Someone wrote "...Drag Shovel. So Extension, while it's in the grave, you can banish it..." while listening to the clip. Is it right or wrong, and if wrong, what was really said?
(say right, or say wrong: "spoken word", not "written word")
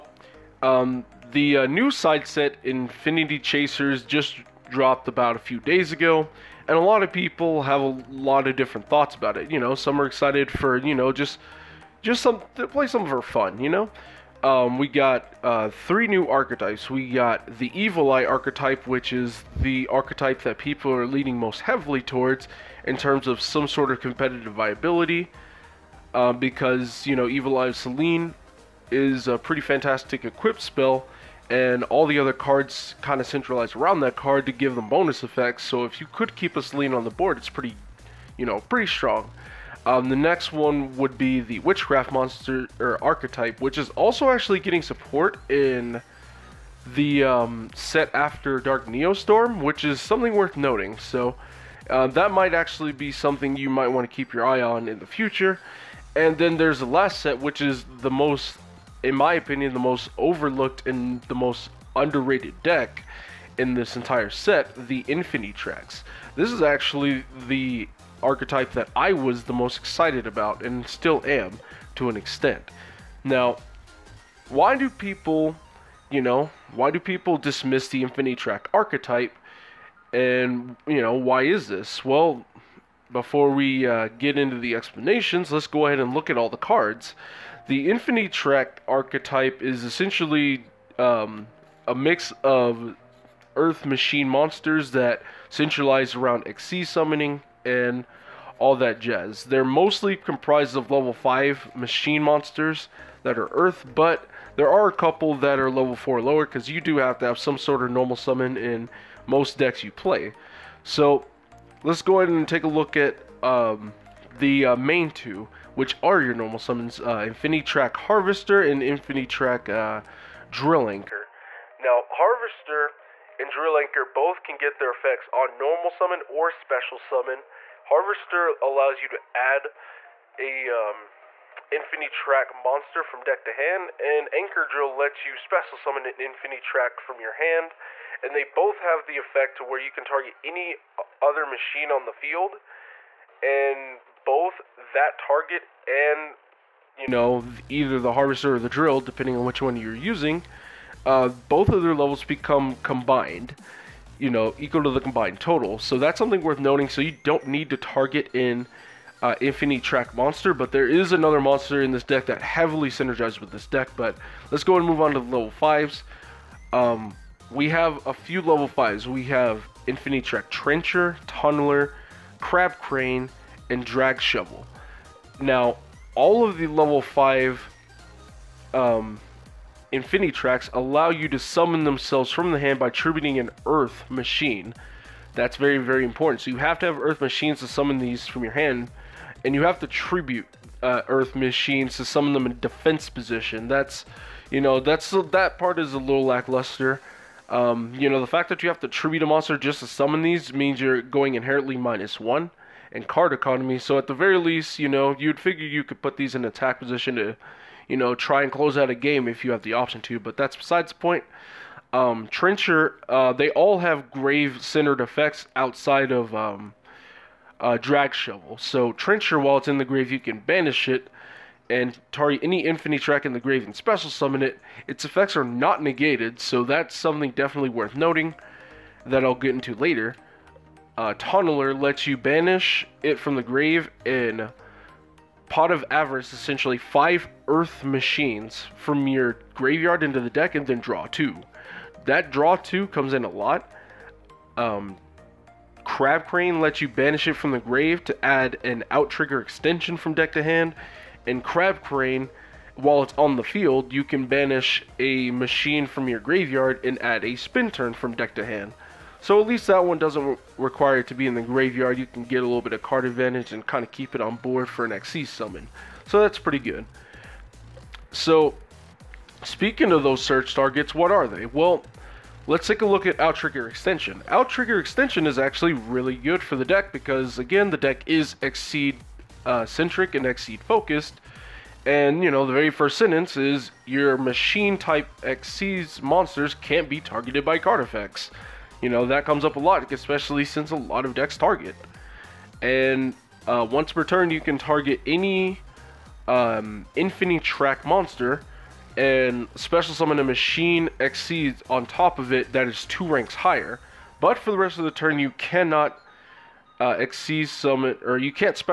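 wrong: "Trencher", not "Extension".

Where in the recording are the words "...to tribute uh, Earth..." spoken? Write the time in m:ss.
3:09.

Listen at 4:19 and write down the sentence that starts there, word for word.
So at least that one doesn't re require it to be in the graveyard.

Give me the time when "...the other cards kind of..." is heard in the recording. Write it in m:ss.
0:32.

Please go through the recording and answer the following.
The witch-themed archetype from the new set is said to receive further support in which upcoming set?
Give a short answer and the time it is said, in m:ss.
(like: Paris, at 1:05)
Dark Neostorm, at 0:48.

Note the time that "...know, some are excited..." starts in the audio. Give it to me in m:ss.
0:09.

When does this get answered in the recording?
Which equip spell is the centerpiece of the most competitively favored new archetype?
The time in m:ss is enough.
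0:27.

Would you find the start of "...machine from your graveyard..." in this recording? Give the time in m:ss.
4:15.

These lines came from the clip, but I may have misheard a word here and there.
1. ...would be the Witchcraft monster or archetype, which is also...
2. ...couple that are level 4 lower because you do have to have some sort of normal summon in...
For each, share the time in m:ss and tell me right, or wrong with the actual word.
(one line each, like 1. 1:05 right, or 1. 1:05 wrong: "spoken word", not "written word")
1. 0:40 right
2. 1:44 right.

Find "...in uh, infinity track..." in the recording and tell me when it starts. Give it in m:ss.
2:38.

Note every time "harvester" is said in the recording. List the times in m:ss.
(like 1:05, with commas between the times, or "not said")
1:57, 2:02, 2:07, 2:28.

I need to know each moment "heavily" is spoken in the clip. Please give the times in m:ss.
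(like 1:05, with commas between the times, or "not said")
0:21, 2:42.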